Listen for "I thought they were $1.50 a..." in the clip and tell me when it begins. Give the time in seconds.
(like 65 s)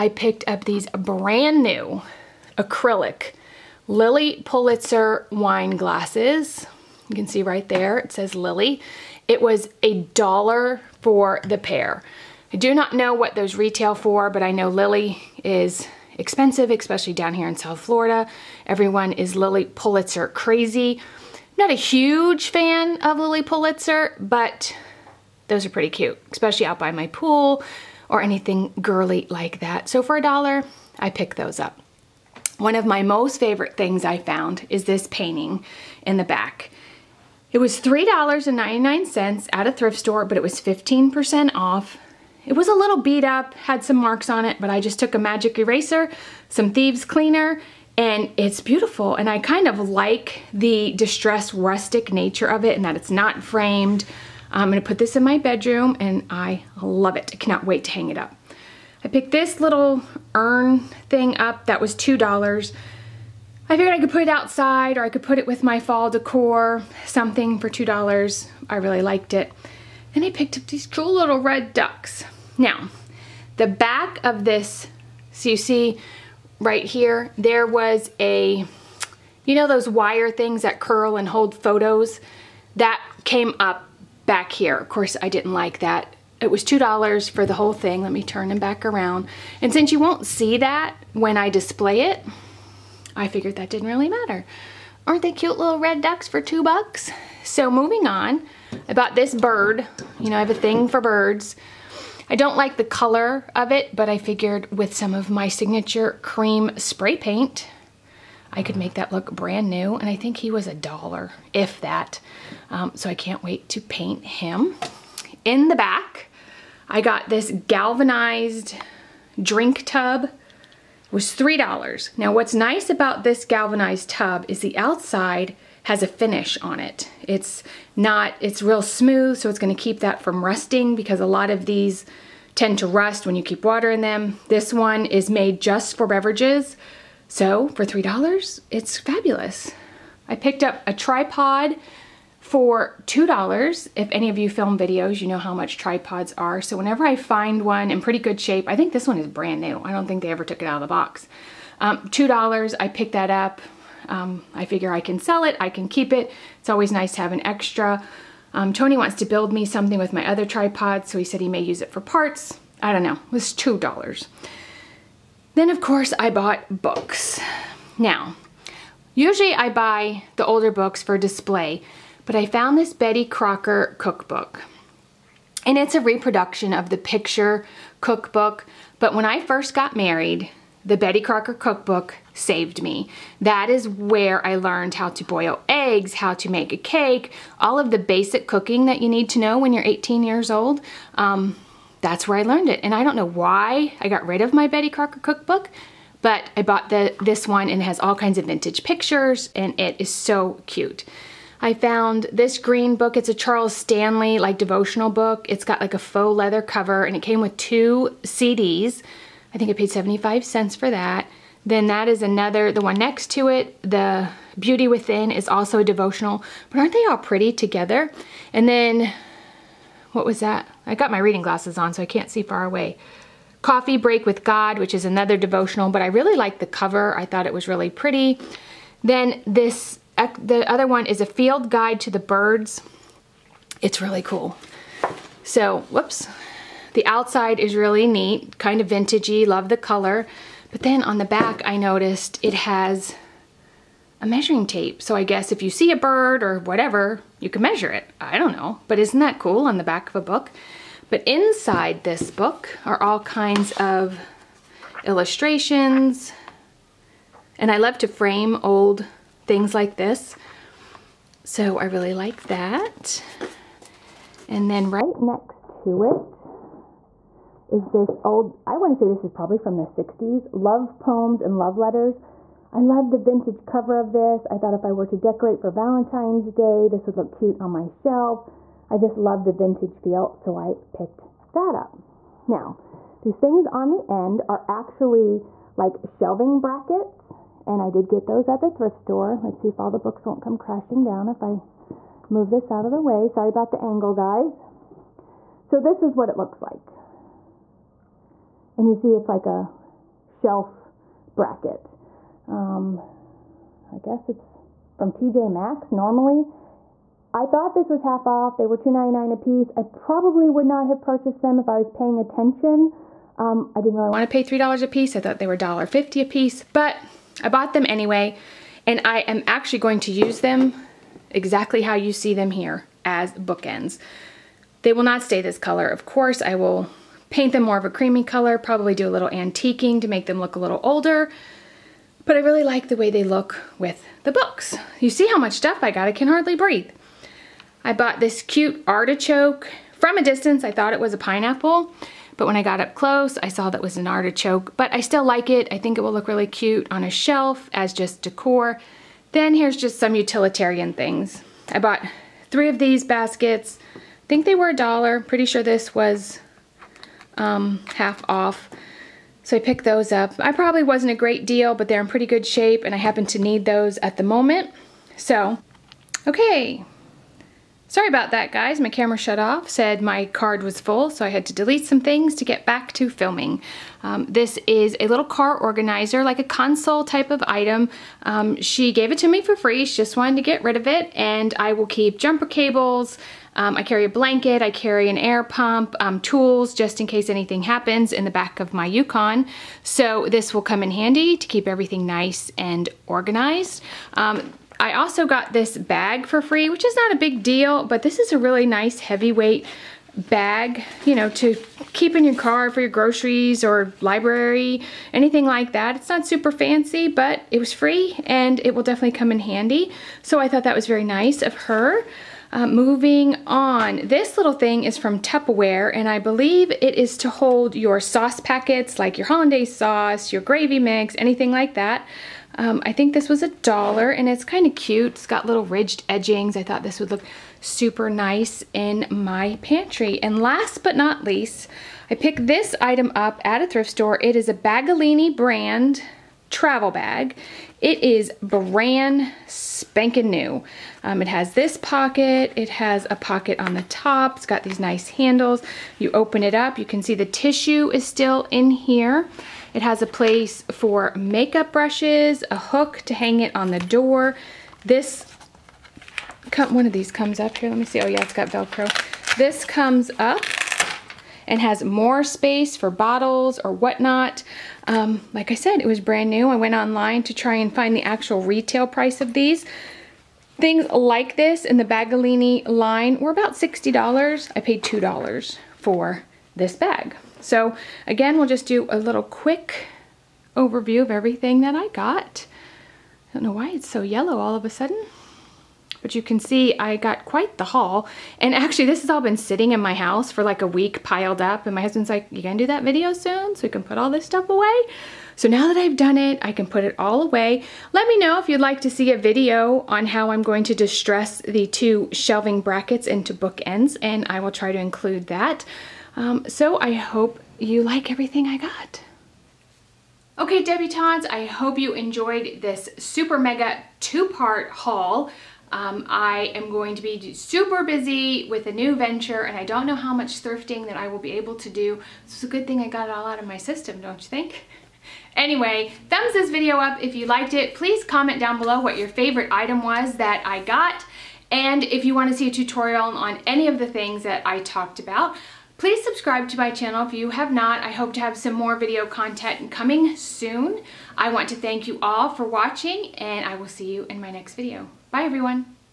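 315 s.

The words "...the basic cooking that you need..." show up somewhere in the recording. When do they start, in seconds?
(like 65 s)
187 s.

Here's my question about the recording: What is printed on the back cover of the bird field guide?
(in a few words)
a measuring tape.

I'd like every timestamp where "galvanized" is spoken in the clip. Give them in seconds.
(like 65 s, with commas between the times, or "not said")
117 s, 123 s.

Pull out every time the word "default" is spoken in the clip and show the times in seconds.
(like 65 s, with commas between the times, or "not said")
not said.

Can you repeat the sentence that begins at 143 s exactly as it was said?
If any of you film videos, you know how much tripods are.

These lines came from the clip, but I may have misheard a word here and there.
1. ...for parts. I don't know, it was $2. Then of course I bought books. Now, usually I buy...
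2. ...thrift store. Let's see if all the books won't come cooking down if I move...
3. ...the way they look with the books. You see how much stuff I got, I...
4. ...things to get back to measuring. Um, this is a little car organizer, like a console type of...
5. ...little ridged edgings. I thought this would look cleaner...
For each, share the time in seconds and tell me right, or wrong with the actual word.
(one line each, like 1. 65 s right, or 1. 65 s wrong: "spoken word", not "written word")
1. 161 s right
2. 288 s wrong: "crashing", not "cooking"
3. 332 s right
4. 372 s wrong: "filming", not "measuring"
5. 425 s wrong: "super", not "cleaner".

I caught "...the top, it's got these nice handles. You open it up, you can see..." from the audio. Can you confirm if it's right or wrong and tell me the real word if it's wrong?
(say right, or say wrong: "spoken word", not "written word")
right.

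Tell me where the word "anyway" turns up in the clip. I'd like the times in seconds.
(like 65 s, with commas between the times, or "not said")
317 s, 525 s.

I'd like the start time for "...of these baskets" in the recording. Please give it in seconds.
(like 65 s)
352 s.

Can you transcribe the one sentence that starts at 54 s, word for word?
I'm gonna put this in my bedroom and I love it.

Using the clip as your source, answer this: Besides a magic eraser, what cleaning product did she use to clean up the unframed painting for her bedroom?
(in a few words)
thieves cleaner.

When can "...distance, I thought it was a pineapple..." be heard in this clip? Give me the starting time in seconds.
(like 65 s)
340 s.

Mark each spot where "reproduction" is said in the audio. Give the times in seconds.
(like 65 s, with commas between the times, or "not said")
176 s.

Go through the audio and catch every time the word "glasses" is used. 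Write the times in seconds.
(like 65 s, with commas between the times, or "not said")
5 s, 221 s.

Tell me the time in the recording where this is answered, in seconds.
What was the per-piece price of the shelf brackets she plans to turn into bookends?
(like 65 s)
308 s.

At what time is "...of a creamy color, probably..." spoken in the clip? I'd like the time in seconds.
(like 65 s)
327 s.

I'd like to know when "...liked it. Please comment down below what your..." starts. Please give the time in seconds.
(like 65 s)
527 s.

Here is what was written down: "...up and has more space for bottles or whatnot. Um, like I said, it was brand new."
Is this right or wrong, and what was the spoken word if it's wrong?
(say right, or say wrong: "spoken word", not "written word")
right.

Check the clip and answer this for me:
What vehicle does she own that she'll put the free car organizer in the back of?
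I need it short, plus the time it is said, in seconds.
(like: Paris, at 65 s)
Yukon, at 388 s.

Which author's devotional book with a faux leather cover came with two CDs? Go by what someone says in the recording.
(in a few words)
Charles Stanley.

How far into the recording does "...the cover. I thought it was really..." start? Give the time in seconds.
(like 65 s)
226 s.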